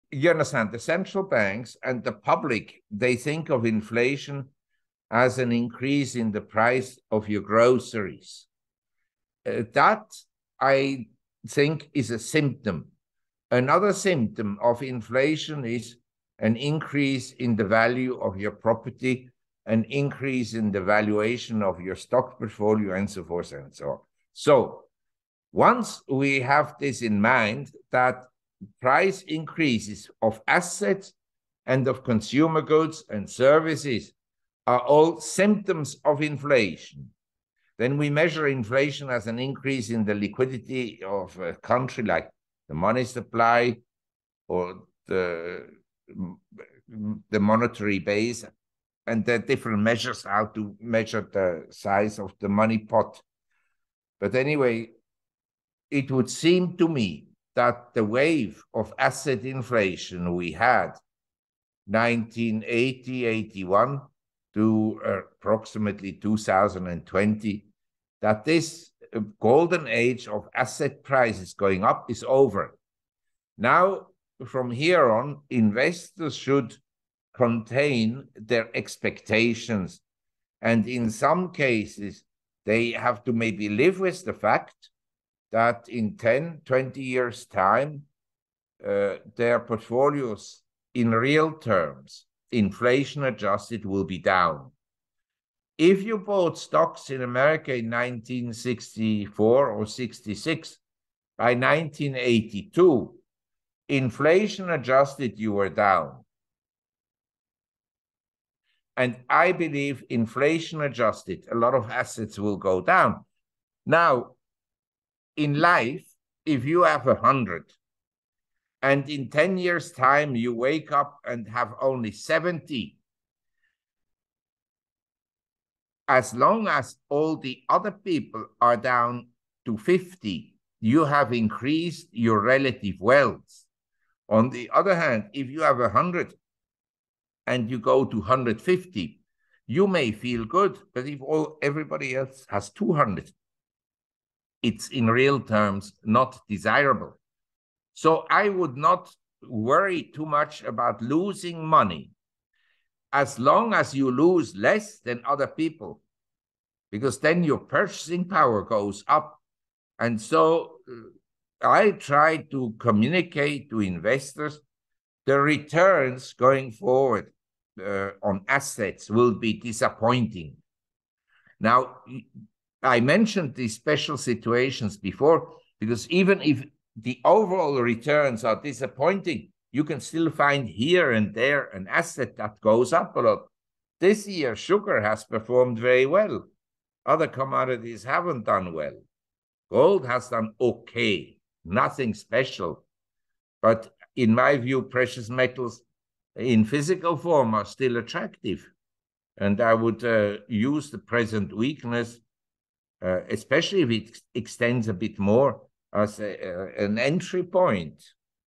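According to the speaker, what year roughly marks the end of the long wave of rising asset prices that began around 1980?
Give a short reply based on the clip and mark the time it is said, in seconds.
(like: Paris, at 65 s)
2020, at 66 s.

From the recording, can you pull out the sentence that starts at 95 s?
If you bought stocks in America in 1964 or 66, by 1982, inflation adjusted, you were down.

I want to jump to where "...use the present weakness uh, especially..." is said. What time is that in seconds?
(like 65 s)
200 s.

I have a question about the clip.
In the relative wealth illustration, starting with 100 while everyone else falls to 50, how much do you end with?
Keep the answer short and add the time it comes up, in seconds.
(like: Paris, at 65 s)
70, at 122 s.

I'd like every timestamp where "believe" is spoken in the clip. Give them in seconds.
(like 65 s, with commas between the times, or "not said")
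109 s.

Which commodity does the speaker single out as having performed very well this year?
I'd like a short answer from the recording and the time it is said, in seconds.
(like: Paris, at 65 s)
Sugar, at 184 s.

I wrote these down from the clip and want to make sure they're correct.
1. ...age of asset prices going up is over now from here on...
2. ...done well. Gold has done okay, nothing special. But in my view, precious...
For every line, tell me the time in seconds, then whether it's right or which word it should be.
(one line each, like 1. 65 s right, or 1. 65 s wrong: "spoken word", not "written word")
1. 69 s right
2. 188 s right.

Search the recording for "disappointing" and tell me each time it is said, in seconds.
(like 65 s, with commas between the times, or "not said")
169 s, 178 s.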